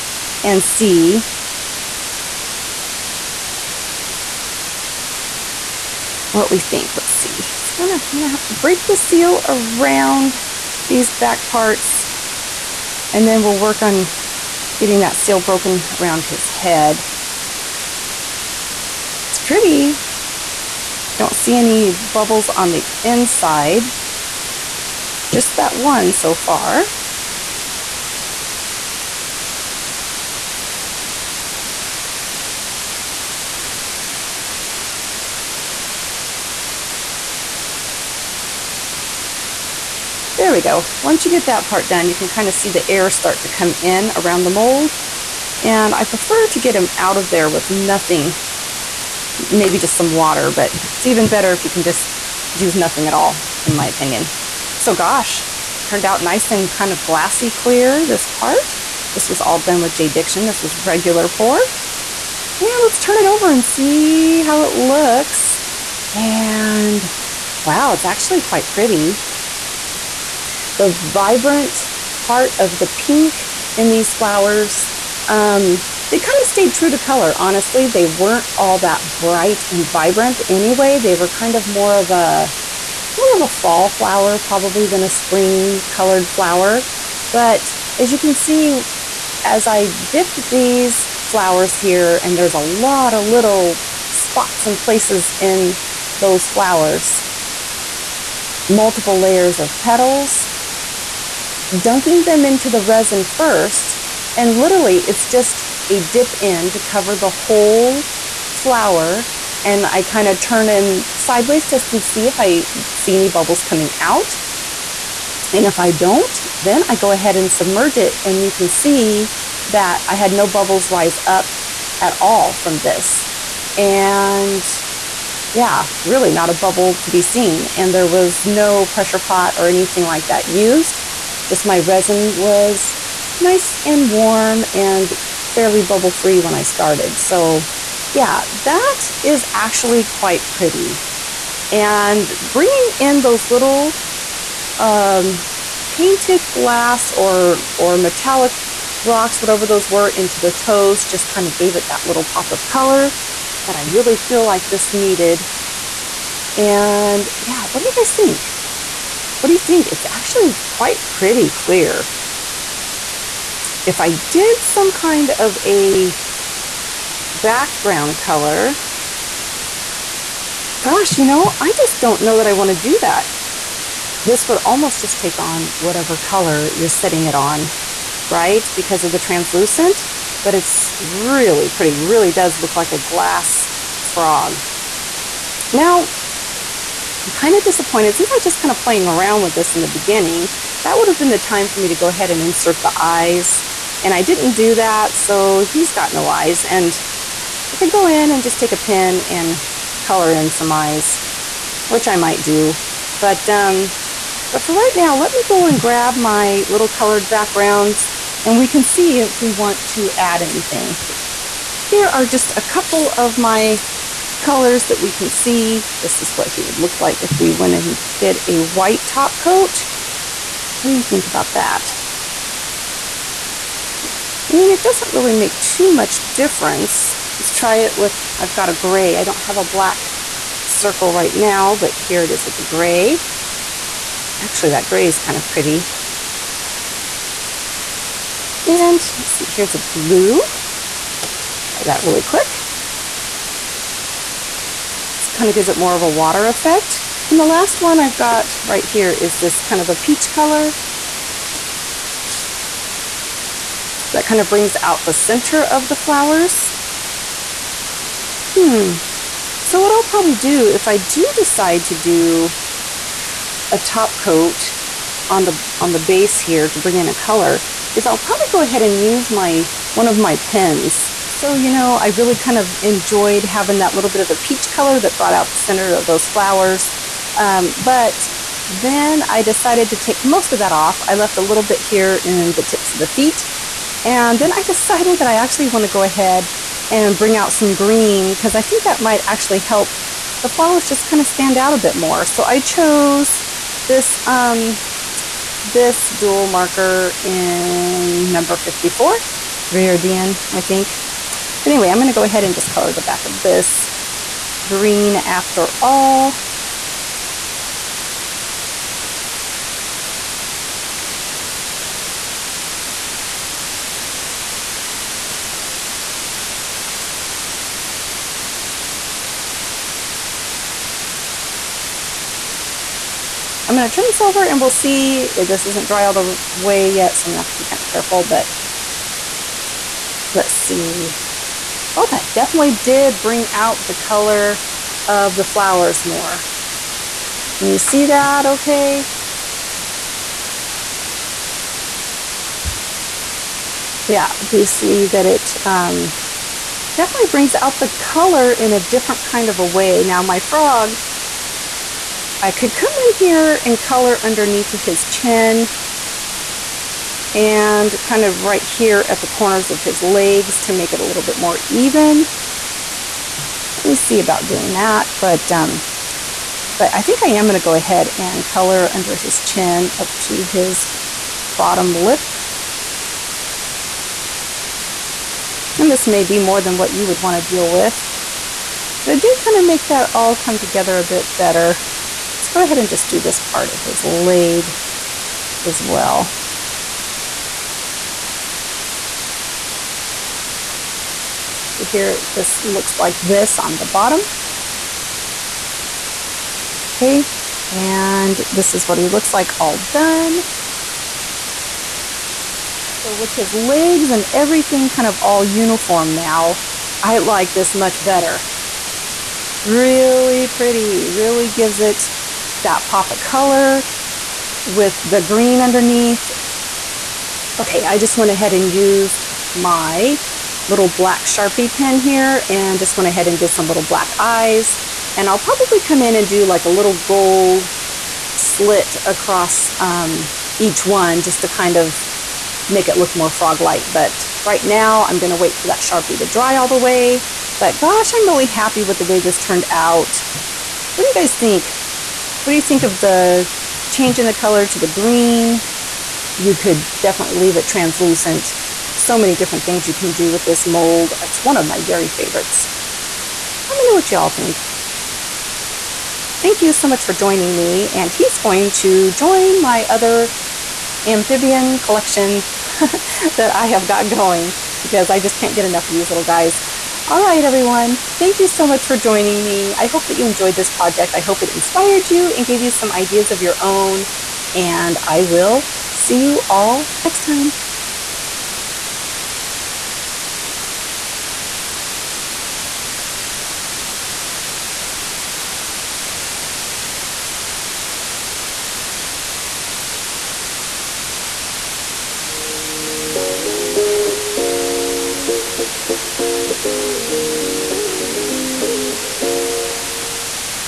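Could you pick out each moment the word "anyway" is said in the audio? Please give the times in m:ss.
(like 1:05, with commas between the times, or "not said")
1:20, 5:01.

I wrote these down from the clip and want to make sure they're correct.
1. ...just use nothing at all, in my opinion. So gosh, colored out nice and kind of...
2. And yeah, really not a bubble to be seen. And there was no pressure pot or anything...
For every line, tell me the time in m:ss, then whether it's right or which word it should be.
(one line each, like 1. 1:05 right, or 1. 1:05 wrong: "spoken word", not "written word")
1. 0:51 wrong: "turned", not "colored"
2. 2:03 right.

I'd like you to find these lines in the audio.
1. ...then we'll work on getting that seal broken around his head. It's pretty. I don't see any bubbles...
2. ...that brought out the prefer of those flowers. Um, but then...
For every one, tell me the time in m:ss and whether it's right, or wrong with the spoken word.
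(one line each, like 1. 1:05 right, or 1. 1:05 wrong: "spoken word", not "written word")
1. 0:13 right
2. 4:34 wrong: "center", not "prefer".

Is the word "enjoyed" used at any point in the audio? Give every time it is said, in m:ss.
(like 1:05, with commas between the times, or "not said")
4:32, 7:50.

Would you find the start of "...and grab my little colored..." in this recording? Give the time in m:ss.
3:25.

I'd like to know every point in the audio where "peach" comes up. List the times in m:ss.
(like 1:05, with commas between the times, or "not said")
4:09, 4:34.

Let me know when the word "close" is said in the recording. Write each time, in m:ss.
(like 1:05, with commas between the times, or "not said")
not said.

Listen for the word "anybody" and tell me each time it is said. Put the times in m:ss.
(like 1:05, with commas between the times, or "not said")
not said.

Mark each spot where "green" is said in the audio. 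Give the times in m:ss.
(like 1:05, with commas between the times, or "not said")
4:47, 5:04, 6:55, 7:24.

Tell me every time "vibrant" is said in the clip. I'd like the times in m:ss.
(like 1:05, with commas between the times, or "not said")
1:10, 1:19.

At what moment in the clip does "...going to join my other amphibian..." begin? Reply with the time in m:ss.
7:38.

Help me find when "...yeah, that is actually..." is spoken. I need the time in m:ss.
2:18.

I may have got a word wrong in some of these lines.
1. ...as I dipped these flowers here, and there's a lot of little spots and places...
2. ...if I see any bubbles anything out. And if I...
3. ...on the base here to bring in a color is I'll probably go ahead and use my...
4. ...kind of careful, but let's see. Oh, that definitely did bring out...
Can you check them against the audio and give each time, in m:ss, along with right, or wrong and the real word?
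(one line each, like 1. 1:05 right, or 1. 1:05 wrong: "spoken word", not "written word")
1. 1:29 right
2. 1:52 wrong: "coming", not "anything"
3. 4:25 right
4. 5:27 right.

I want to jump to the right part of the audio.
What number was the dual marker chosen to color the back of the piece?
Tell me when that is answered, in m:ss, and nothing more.
4:58.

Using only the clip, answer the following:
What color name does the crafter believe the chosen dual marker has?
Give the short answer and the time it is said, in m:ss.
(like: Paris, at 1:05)
Viridian, at 4:59.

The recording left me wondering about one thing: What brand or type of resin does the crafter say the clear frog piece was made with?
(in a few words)
JDiction.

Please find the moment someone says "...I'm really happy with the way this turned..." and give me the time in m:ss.
7:18.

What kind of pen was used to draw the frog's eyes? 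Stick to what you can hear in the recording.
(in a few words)
black Sharpie.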